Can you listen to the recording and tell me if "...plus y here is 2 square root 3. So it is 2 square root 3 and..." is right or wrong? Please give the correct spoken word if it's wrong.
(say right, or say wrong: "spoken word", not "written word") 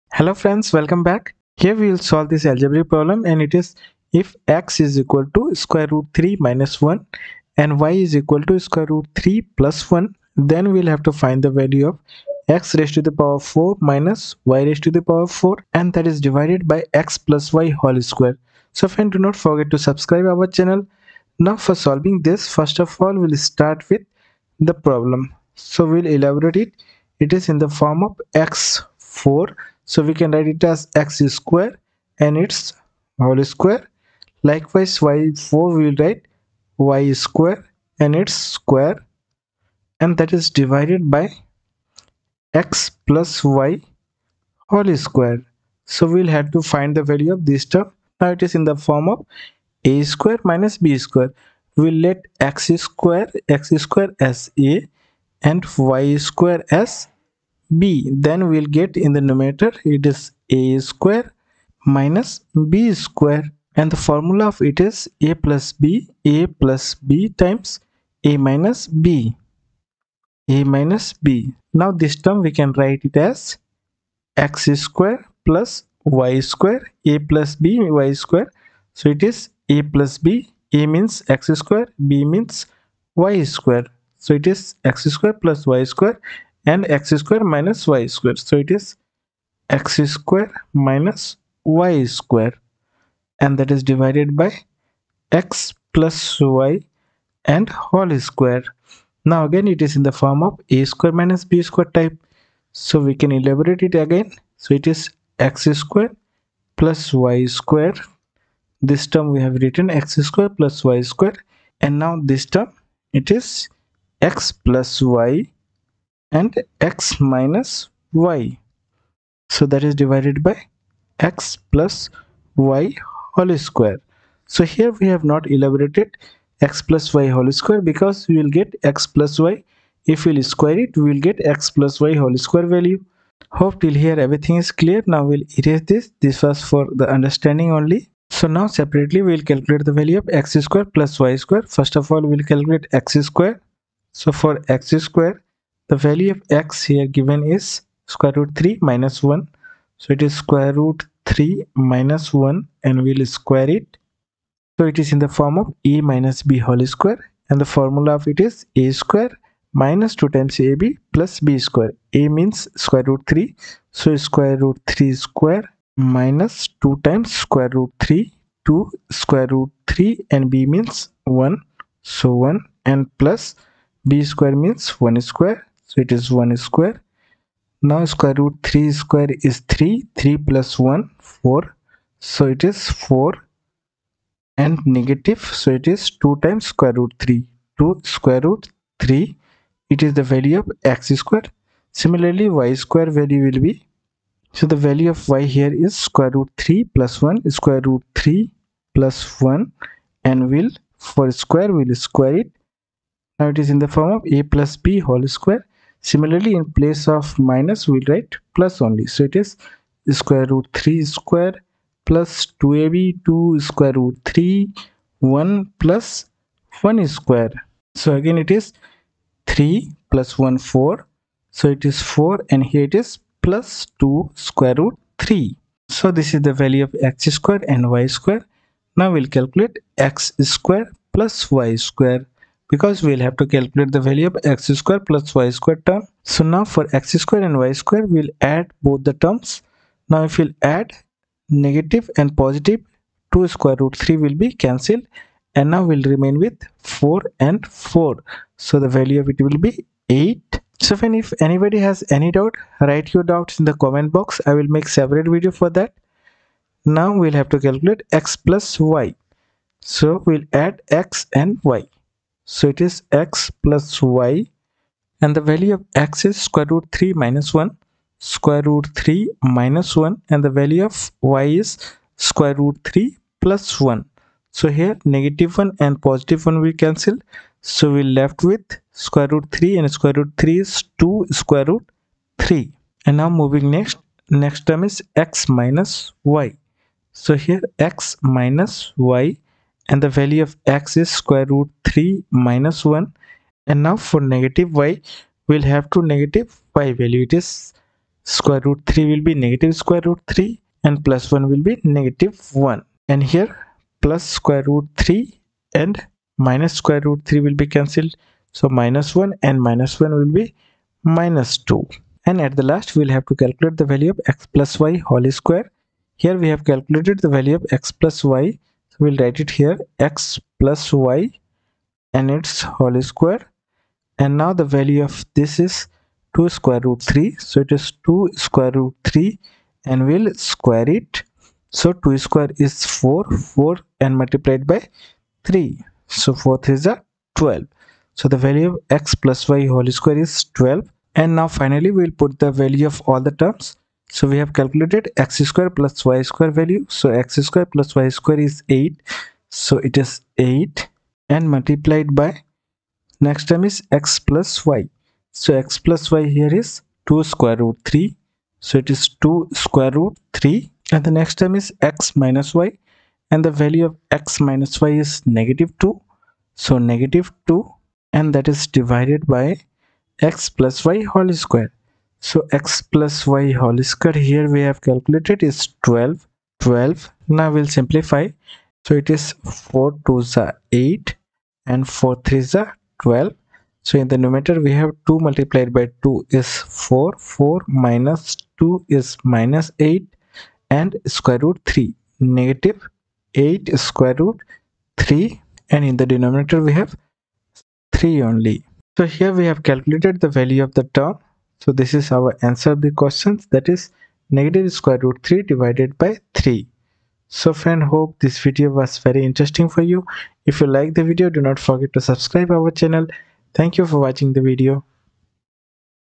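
right.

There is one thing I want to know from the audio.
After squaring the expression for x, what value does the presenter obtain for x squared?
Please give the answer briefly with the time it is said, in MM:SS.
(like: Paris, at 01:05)
4 - 2√3, at 03:02.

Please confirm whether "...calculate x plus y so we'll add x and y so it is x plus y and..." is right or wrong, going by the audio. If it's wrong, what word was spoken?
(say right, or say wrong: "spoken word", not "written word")
right.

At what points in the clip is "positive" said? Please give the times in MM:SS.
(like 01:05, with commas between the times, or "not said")
04:02, 04:36.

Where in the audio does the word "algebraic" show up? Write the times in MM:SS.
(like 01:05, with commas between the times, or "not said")
00:02.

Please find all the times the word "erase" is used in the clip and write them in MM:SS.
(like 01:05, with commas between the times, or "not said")
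02:15.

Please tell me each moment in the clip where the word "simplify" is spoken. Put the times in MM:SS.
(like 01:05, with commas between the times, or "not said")
06:17.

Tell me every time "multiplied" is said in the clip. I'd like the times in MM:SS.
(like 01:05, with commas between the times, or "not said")
05:34, 05:51, 06:25.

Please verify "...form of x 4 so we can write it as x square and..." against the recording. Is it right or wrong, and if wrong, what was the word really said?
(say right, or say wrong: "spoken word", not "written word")
right.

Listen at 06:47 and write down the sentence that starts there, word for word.
So friend hope this video was very interesting for you.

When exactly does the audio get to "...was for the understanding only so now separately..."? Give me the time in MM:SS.
02:16.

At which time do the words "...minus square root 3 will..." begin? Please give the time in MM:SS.
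05:06.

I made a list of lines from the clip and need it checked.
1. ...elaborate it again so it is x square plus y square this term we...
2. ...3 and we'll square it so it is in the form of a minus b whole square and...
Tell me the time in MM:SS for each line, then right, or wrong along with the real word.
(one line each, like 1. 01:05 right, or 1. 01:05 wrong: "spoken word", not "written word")
1. 01:43 right
2. 02:32 wrong: "1", not "3".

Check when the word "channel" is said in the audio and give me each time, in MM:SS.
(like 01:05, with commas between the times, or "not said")
00:20, 06:52.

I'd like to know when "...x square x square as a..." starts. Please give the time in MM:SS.
00:52.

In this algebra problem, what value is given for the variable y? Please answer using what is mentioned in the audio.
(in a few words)
√3 + 1.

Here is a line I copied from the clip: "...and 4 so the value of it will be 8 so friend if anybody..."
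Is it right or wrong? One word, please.
right.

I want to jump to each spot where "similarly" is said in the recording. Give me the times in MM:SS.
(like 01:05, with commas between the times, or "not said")
03:12, 03:26.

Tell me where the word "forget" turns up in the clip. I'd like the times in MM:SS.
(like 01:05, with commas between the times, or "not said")
00:19, 06:51.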